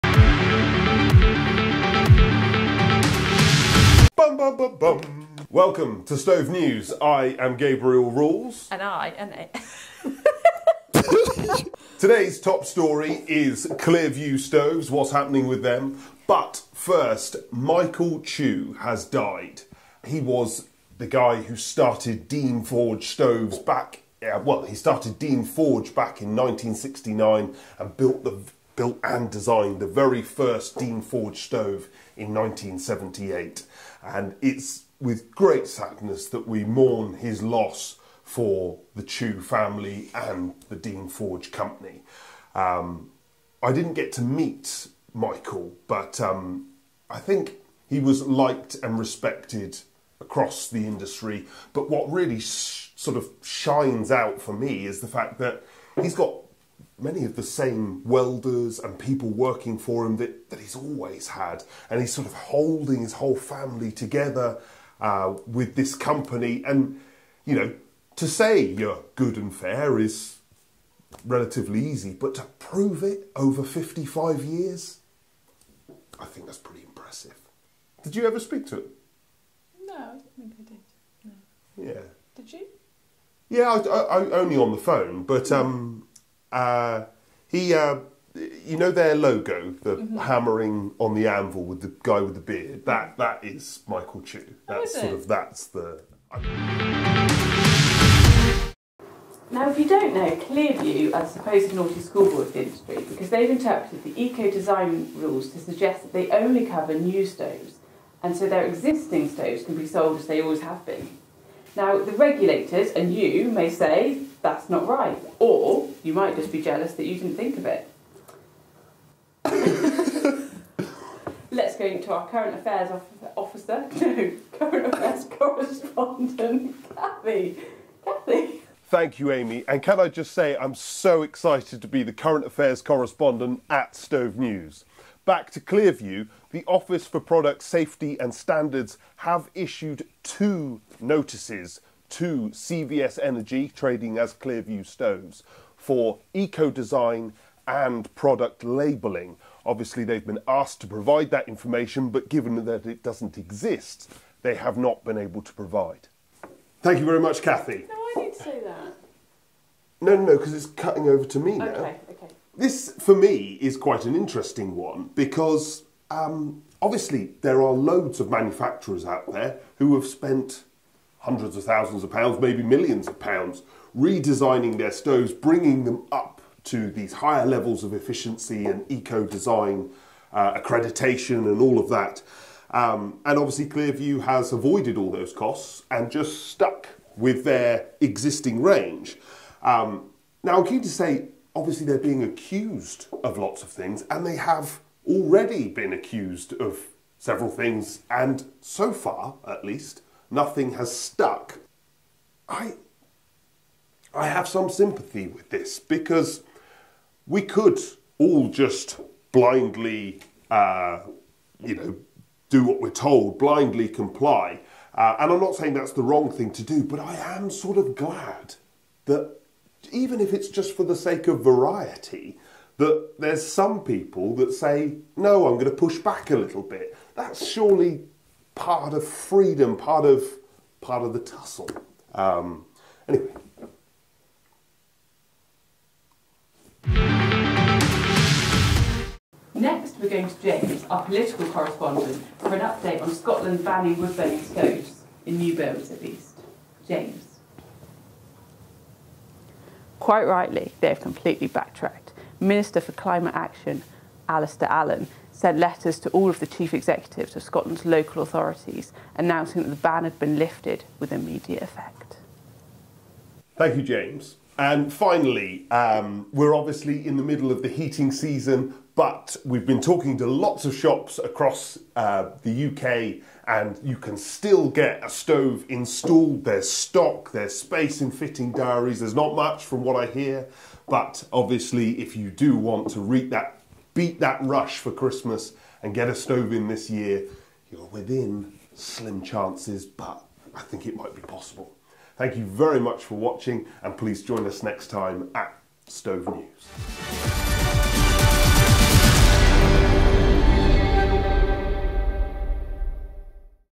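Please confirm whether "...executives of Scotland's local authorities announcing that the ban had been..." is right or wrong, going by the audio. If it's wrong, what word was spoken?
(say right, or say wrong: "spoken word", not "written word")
right.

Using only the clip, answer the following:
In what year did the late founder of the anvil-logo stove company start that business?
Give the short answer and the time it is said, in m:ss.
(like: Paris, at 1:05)
1969, at 0:26.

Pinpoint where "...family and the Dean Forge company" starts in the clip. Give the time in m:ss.
0:39.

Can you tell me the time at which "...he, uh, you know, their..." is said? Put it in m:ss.
1:27.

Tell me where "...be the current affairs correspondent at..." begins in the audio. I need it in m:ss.
2:11.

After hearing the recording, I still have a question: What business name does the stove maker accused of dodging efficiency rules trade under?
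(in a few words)
CVS Energy.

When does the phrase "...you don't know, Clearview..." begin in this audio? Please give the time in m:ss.
1:39.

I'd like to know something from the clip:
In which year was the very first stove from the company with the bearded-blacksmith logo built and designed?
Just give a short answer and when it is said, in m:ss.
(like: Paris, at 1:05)
1978, at 0:32.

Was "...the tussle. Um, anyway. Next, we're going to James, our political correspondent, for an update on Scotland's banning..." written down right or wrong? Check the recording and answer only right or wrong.
right.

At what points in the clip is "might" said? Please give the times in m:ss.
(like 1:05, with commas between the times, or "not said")
1:56, 4:50.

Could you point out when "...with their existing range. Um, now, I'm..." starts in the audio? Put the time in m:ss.
3:07.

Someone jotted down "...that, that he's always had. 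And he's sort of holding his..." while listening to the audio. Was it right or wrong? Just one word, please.
right.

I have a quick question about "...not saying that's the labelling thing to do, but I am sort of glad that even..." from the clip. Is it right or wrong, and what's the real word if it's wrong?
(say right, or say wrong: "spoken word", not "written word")
wrong: "wrong", not "labelling".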